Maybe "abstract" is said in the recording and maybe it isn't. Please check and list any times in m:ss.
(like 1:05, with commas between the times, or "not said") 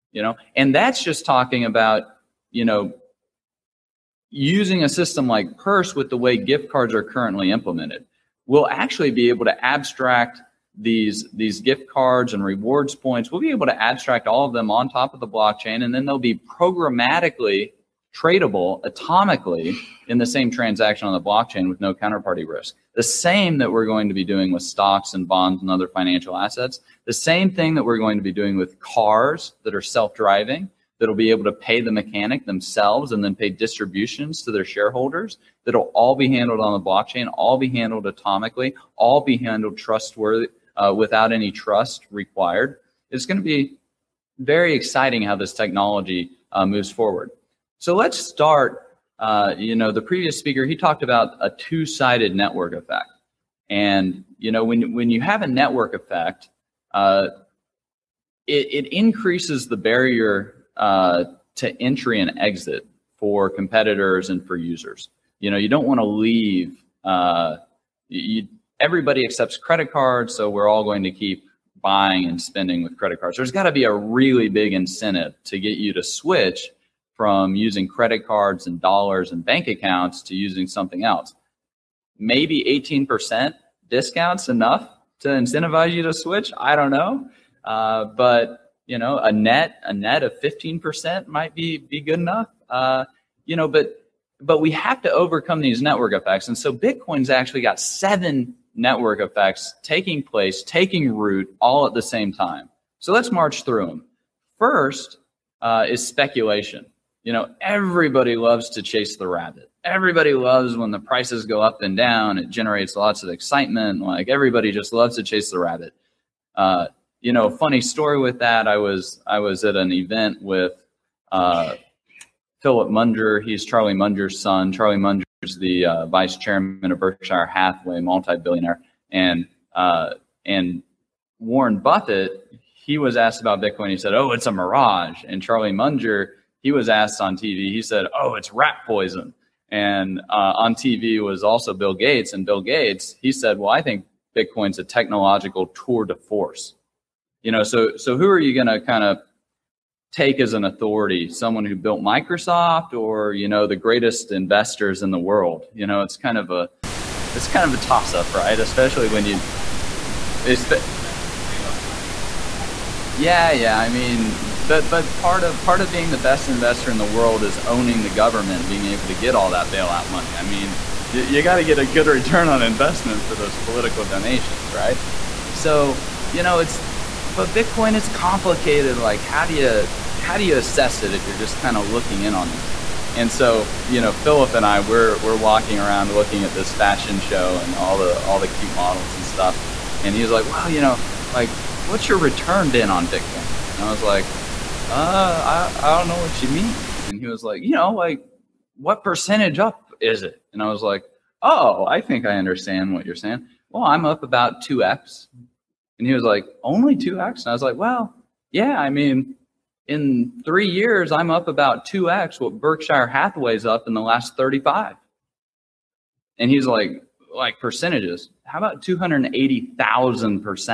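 0:09, 0:13.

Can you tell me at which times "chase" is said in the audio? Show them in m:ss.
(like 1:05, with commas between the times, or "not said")
1:48, 1:55.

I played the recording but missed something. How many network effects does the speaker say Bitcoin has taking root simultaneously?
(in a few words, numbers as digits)
7.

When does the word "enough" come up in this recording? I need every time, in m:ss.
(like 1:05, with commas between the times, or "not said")
1:24, 1:32.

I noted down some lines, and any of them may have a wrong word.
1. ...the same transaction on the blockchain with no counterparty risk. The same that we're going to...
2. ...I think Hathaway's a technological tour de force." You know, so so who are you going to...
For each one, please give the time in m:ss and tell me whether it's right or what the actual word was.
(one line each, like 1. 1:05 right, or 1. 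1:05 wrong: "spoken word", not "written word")
1. 0:20 right
2. 2:23 wrong: "Bitcoin", not "Hathaway".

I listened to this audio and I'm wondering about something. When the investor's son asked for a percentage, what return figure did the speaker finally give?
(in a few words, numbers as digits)
280,000%.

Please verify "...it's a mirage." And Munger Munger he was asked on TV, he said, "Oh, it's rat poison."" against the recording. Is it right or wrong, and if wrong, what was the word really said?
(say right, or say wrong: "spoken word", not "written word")
wrong: "Charlie", not "Munger".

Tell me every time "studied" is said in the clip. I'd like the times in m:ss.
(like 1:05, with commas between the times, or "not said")
not said.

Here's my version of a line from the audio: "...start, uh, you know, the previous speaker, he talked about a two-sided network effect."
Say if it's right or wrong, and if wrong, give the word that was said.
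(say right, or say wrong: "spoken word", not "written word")
right.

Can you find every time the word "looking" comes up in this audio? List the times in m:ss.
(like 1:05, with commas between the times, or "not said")
3:01, 3:06.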